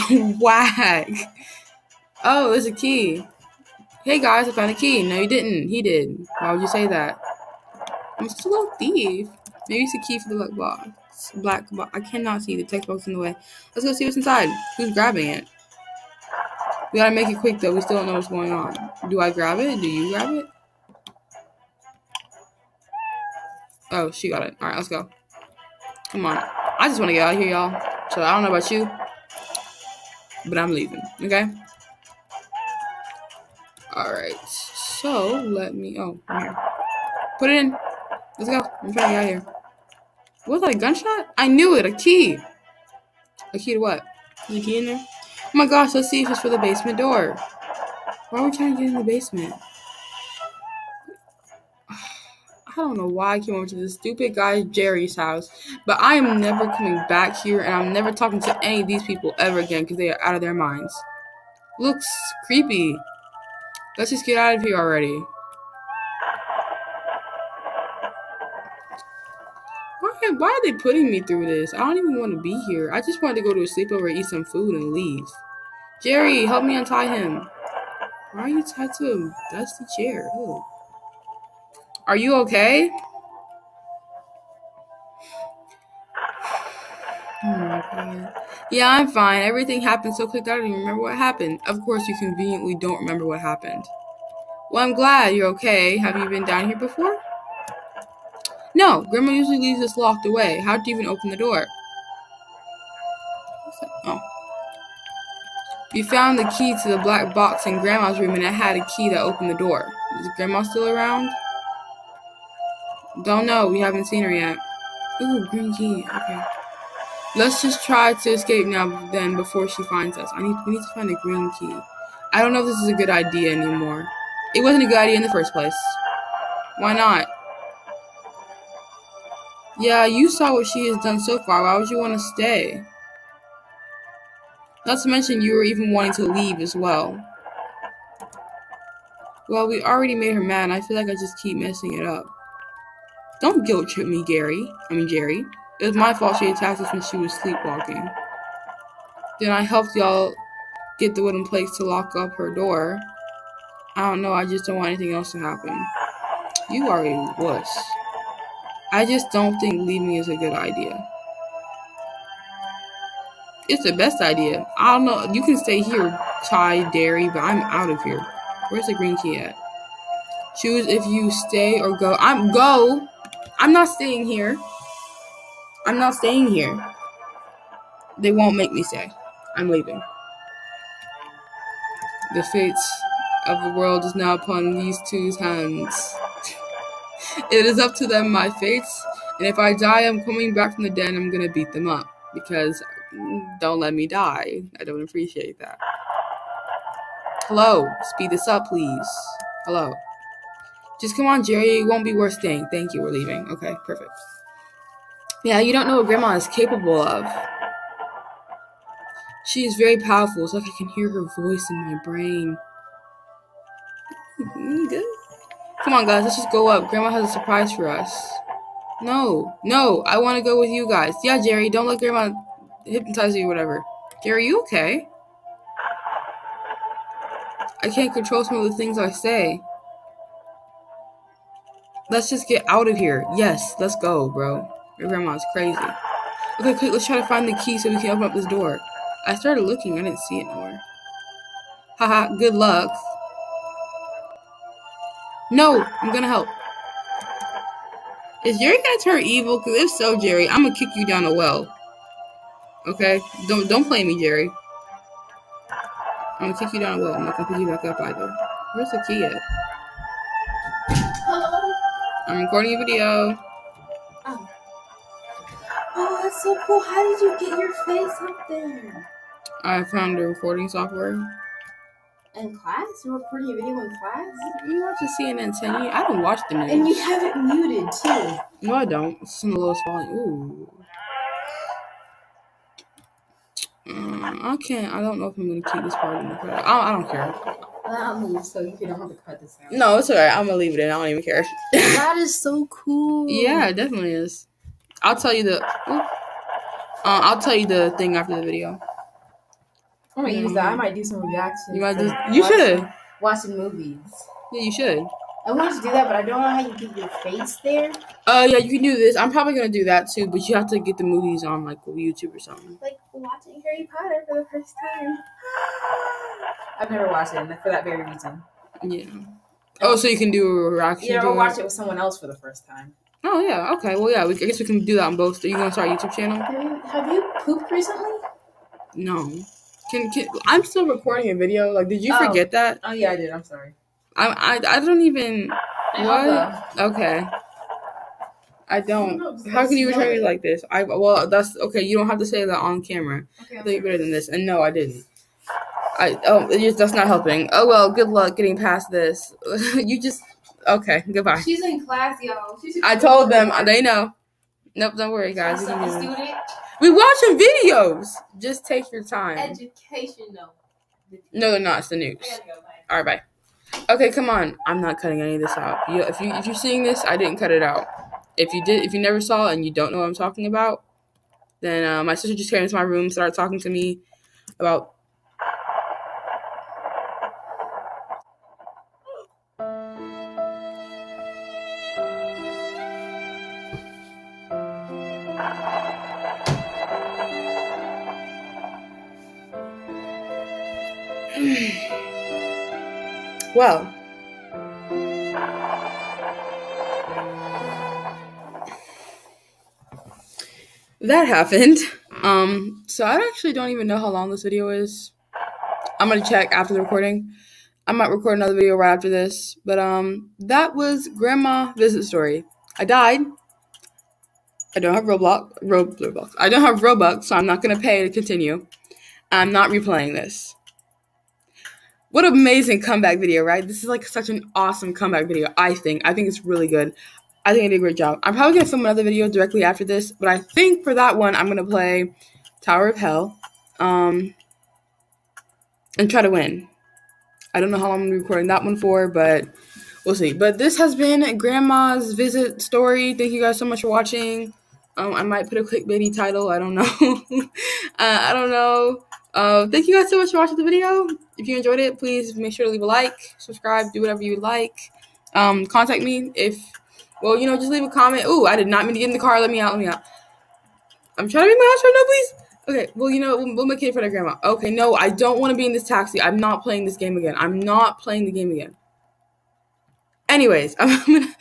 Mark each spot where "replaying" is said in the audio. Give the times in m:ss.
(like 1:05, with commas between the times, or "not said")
6:59.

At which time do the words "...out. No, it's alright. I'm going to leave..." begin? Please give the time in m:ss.
4:49.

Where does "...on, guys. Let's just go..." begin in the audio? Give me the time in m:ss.
3:35.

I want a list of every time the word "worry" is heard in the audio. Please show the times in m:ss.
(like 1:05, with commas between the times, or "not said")
5:55.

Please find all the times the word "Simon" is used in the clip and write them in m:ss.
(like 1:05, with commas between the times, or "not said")
not said.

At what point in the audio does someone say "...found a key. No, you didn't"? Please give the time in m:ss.
0:04.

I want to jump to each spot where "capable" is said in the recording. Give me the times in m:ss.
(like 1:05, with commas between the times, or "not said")
3:26.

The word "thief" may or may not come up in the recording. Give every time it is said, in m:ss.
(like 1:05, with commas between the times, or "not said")
0:08.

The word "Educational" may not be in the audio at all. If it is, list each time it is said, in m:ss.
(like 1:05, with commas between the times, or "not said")
5:59.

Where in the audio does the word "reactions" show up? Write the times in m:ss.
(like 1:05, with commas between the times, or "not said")
5:01, 5:20.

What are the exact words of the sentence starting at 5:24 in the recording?
We, I guess we can do that on both.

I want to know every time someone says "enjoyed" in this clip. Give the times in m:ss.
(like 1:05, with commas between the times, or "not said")
7:31.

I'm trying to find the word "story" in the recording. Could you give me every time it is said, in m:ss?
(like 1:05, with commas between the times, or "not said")
6:52, 7:22.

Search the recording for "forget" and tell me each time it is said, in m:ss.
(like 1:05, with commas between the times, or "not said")
5:32.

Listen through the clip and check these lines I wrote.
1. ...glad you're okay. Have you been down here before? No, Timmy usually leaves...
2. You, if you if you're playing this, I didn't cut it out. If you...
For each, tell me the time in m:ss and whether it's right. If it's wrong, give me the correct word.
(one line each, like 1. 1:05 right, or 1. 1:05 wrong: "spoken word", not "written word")
1. 1:34 wrong: "Grandma", not "Timmy"
2. 6:05 wrong: "seeing", not "playing".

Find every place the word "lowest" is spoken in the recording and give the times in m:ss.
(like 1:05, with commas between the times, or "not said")
4:39.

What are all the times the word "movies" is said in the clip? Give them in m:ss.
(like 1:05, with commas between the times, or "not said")
5:03, 5:11.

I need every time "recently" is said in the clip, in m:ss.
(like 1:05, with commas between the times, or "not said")
5:27.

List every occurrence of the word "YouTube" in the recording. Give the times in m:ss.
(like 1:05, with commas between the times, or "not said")
5:11, 5:25.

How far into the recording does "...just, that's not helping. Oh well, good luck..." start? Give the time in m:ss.
5:46.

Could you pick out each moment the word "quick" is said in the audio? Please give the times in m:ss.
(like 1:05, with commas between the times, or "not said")
0:17, 1:30, 3:56.